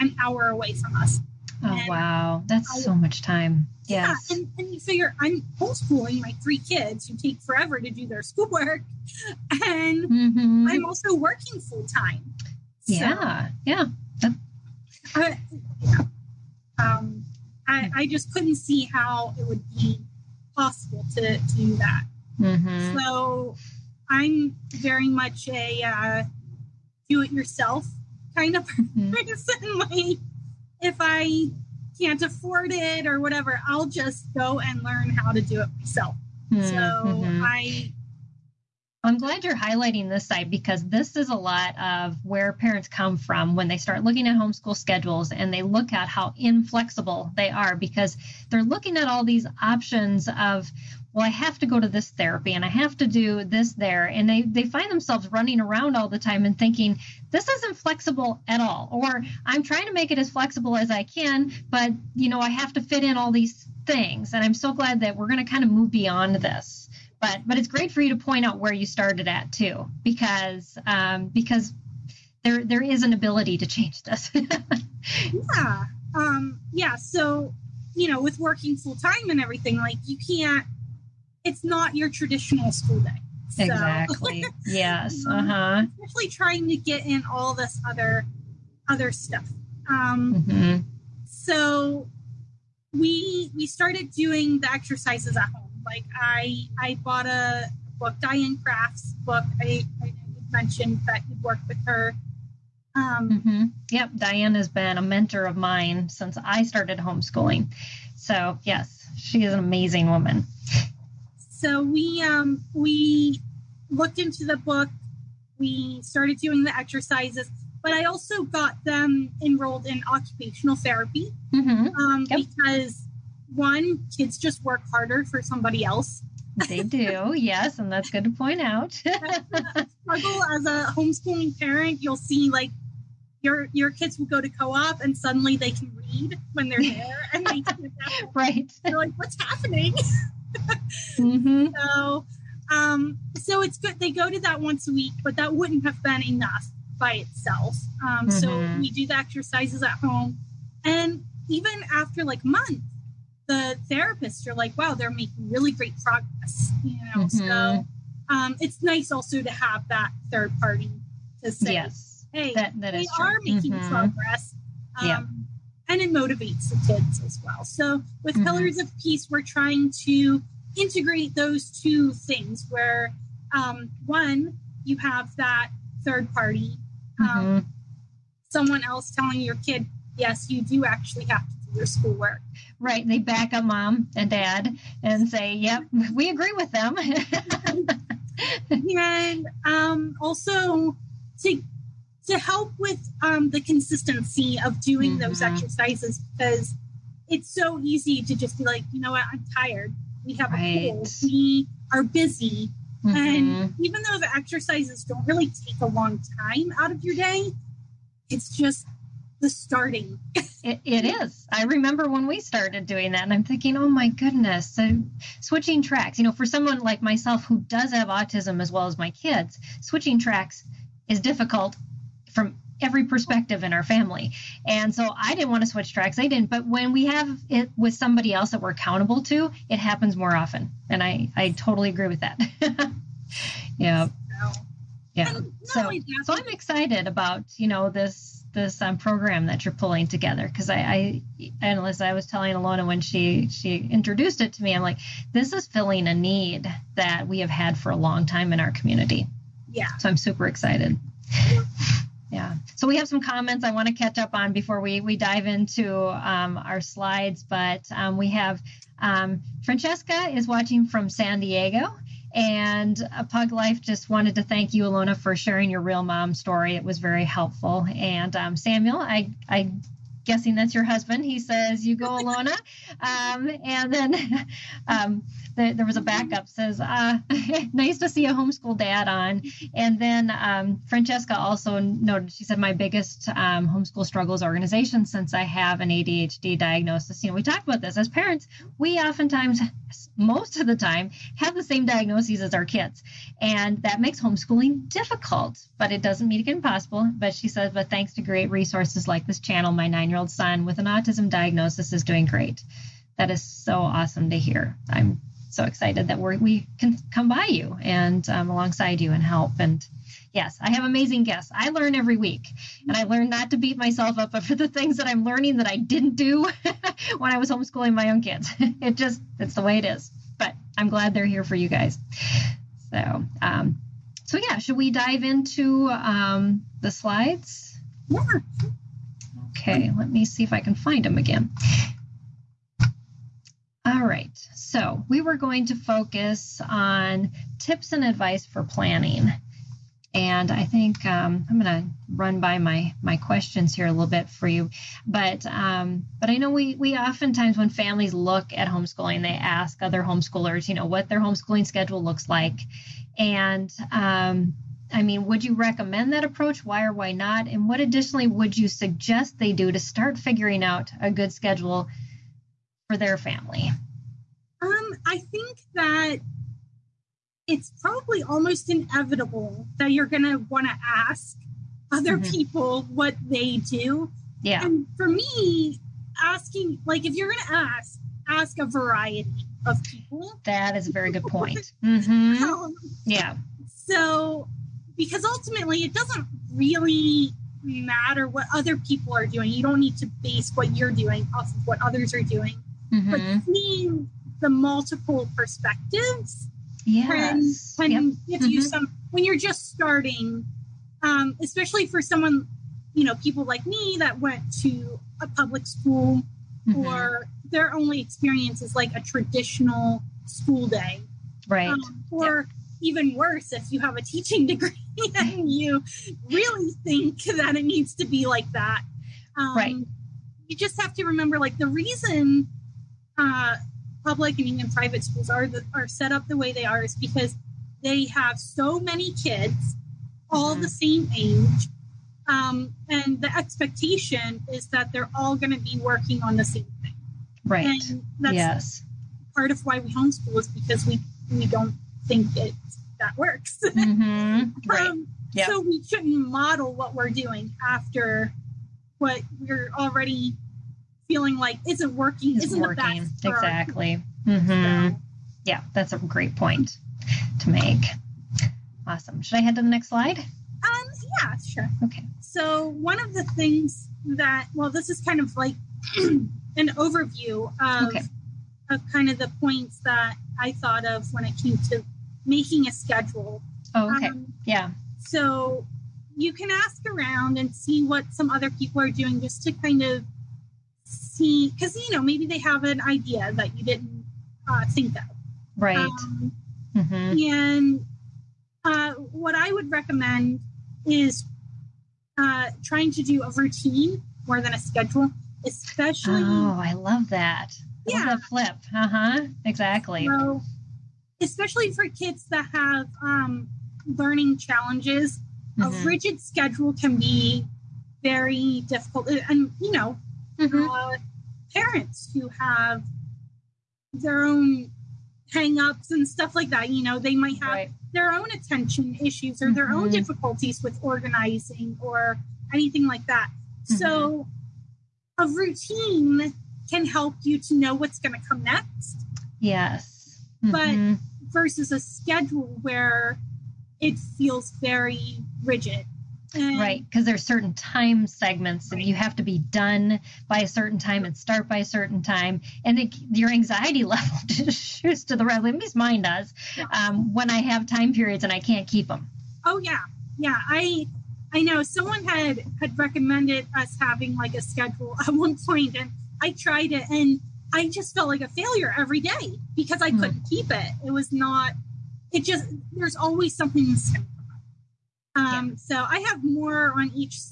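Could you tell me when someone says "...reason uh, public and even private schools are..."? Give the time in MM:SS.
07:01.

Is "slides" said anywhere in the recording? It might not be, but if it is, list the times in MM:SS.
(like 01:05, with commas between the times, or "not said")
04:16, 05:26, 07:39.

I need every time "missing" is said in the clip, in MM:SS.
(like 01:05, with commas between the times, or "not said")
09:23.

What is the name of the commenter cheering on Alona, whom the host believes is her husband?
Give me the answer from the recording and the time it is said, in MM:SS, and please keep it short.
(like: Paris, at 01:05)
Samuel, at 04:28.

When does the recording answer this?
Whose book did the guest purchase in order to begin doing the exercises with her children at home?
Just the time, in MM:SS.
01:38.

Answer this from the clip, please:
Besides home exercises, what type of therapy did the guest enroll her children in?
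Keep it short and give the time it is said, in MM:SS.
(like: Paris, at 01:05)
Occupational therapy, at 02:00.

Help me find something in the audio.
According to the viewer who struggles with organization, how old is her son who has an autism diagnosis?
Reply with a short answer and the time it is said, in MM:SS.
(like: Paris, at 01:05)
9, at 04:59.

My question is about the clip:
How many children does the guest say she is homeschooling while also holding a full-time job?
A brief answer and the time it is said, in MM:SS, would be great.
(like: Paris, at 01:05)
3, at 00:06.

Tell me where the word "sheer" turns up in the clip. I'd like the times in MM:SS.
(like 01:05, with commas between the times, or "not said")
not said.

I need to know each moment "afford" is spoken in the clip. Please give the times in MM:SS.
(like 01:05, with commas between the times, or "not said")
00:32.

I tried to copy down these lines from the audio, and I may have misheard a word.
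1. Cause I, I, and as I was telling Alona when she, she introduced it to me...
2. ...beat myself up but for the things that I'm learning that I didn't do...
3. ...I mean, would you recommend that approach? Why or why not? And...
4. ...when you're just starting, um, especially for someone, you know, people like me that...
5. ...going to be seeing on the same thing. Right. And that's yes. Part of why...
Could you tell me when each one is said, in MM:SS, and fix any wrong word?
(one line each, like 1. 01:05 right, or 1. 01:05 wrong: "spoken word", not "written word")
1. 04:00 right
2. 05:13 right
3. 05:54 right
4. 06:39 right
5. 07:15 wrong: "working", not "seeing".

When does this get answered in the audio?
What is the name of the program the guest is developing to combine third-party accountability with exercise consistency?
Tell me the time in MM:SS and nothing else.
02:48.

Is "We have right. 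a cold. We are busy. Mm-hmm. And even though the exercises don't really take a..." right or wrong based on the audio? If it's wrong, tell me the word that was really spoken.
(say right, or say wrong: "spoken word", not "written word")
right.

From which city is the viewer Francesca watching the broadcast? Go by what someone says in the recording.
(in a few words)
San Diego.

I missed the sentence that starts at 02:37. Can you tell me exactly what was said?
so um, it's nice also to have that third party to say, yes, "Hey, that, that they are making mm-hmm.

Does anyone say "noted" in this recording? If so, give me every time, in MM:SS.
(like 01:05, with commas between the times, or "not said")
04:41.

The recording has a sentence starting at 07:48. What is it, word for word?
of kind of the points that I thought of when it came to making a schedule.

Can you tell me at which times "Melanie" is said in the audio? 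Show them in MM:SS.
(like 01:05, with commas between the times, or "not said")
not said.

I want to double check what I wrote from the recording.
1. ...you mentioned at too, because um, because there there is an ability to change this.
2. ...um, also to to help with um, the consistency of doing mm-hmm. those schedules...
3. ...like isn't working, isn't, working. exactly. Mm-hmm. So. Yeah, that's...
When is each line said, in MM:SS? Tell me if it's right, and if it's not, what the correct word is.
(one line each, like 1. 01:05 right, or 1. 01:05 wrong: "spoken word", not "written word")
1. 01:08 wrong: "started", not "mentioned"
2. 03:09 wrong: "exercises", not "schedules"
3. 07:31 right.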